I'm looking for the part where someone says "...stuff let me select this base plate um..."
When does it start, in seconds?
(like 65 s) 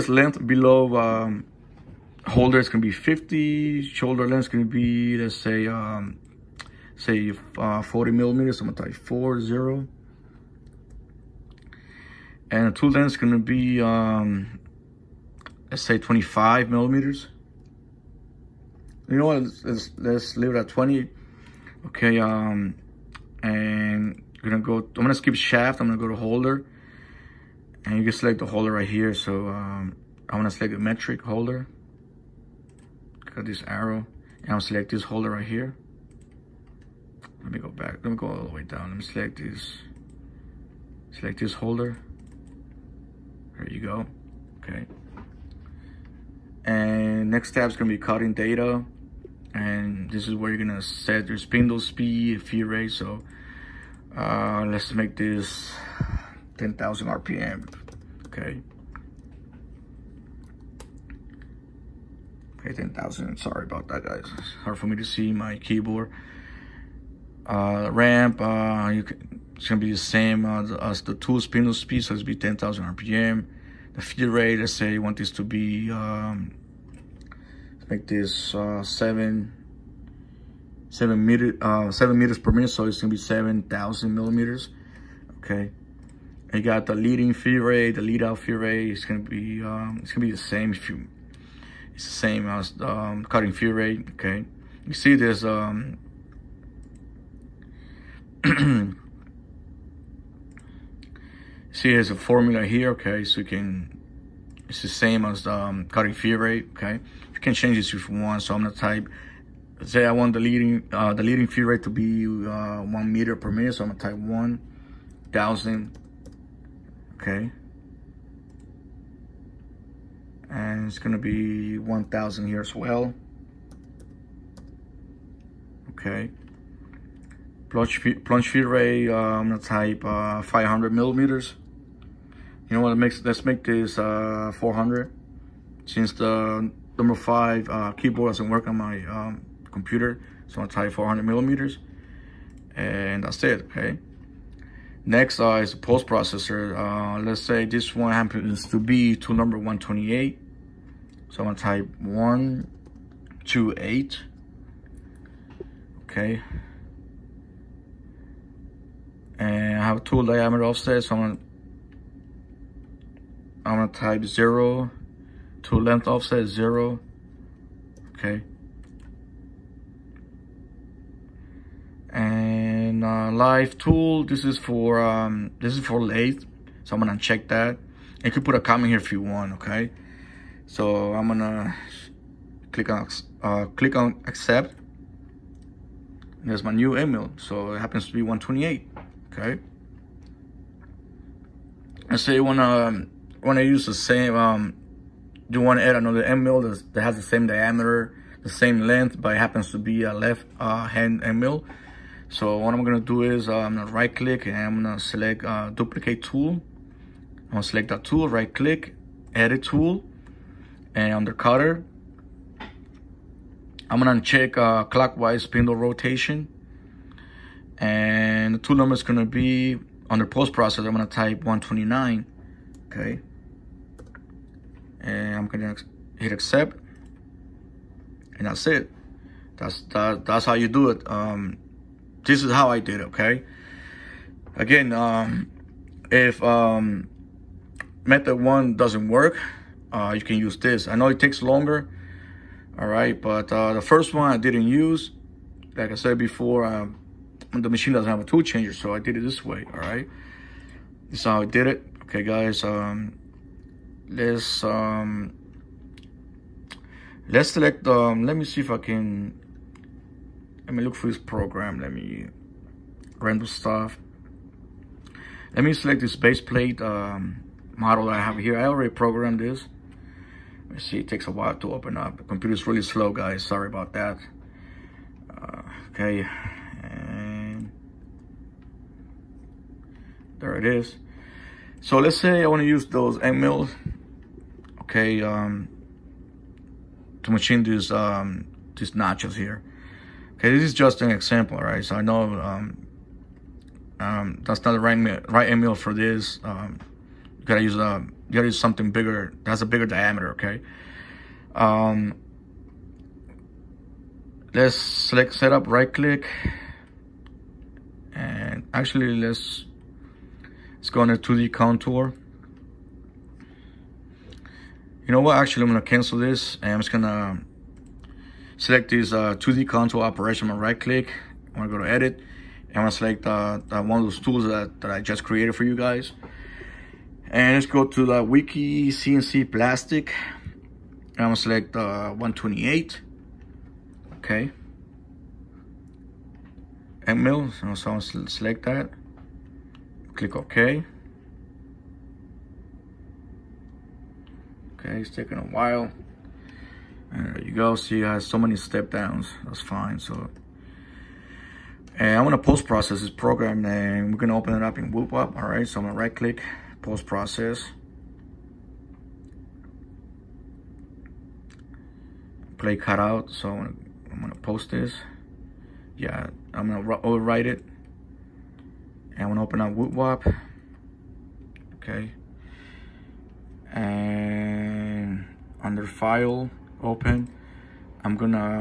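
263 s.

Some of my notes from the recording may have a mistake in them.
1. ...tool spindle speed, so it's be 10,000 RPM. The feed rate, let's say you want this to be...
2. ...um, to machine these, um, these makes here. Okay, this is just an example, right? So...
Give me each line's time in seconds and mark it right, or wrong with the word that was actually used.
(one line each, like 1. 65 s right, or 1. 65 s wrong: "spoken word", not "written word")
1. 71 s right
2. 285 s wrong: "notches", not "makes".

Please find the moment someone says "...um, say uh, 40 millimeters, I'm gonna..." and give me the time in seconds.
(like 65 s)
5 s.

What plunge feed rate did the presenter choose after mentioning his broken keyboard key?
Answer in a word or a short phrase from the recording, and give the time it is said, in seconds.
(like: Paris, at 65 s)
400 millimeters, at 140 s.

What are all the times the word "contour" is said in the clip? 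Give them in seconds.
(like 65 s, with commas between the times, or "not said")
311 s, 319 s.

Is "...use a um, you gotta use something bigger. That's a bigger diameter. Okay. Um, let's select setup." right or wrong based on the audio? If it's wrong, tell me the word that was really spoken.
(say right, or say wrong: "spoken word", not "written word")
right.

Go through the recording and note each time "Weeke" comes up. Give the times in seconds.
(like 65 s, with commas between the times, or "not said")
328 s.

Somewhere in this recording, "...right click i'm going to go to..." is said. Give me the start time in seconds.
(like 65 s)
320 s.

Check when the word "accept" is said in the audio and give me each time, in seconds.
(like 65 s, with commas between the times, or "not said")
184 s, 226 s.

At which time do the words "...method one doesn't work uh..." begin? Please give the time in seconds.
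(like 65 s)
238 s.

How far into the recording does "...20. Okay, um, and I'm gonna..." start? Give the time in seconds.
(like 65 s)
20 s.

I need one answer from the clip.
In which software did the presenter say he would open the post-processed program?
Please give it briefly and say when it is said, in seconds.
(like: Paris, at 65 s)
woodWOP, at 354 s.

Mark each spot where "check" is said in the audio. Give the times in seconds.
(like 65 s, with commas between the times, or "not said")
177 s, 214 s.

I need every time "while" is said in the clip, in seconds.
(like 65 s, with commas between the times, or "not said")
271 s, 345 s.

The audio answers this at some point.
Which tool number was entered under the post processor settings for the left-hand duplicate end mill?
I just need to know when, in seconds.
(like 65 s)
221 s.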